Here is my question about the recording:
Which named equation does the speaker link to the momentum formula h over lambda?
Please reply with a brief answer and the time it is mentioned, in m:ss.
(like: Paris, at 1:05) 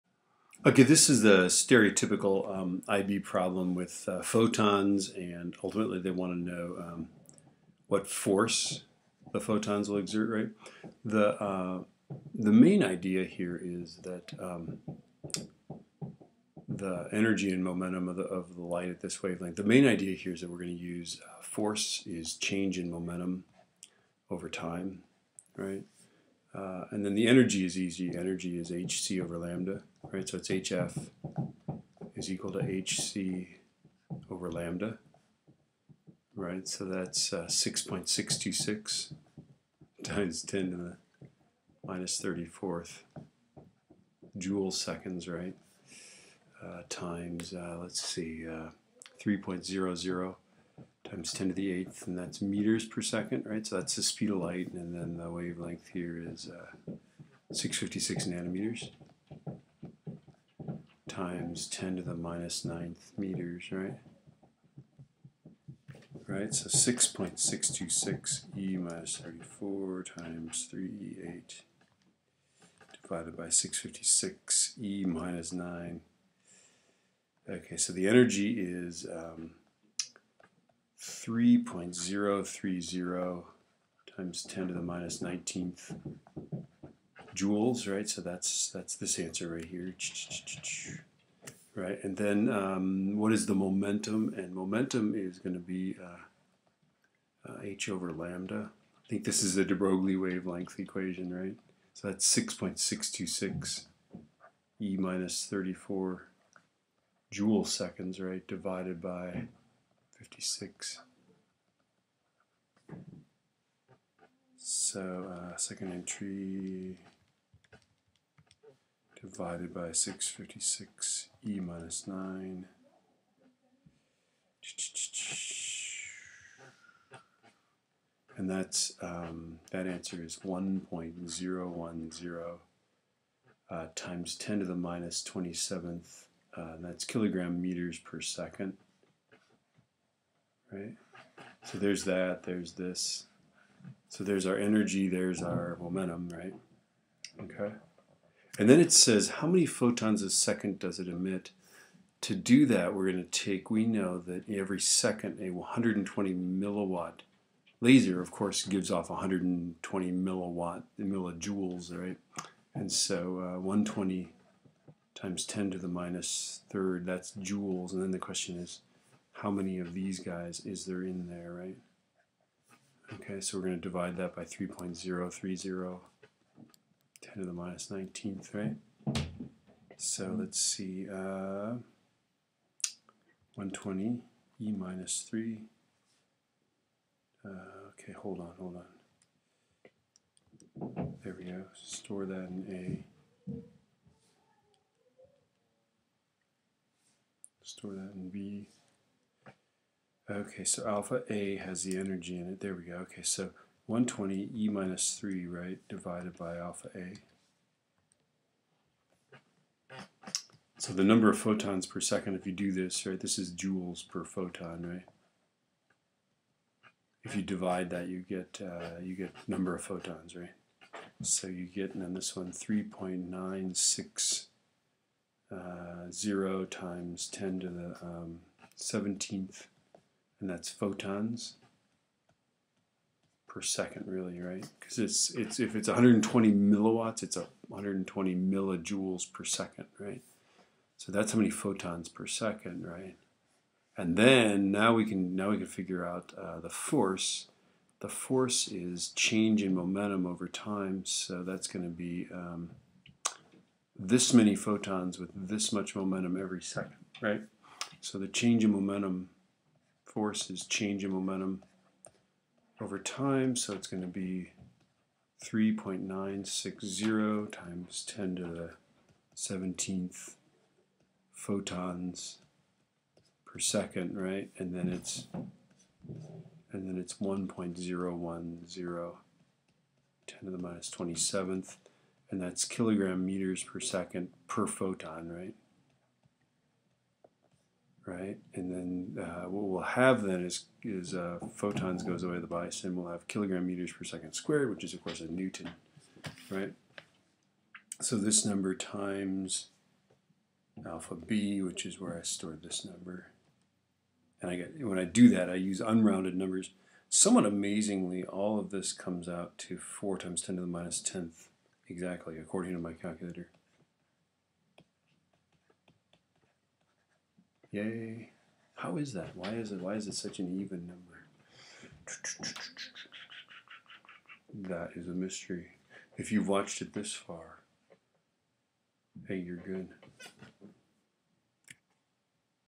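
de Broglie wavelength equation, at 1:39.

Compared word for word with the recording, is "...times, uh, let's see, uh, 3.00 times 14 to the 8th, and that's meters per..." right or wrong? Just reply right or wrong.
wrong.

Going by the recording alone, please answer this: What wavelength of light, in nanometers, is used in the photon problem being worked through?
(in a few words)
656 nanometers.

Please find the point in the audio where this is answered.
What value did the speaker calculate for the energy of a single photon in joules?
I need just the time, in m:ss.
1:20.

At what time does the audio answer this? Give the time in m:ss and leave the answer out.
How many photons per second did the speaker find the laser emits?
3:42.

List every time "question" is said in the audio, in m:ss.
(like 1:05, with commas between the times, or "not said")
2:48.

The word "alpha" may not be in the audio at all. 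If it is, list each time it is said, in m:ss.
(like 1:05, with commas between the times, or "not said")
3:20, 3:26, 5:00.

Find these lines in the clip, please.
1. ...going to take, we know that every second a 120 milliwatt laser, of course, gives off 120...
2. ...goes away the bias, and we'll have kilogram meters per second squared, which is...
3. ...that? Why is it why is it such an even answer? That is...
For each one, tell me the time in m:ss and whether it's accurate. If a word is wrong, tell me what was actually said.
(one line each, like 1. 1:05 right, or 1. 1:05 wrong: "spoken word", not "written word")
1. 2:33 right
2. 4:52 right
3. 5:19 wrong: "number", not "answer".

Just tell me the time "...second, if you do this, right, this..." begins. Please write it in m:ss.
3:31.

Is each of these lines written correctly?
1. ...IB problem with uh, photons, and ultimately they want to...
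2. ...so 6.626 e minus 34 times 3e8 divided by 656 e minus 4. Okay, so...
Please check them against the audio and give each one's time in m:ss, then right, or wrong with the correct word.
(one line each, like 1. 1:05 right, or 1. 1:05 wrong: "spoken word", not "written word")
1. 0:02 right
2. 1:06 wrong: "9", not "4".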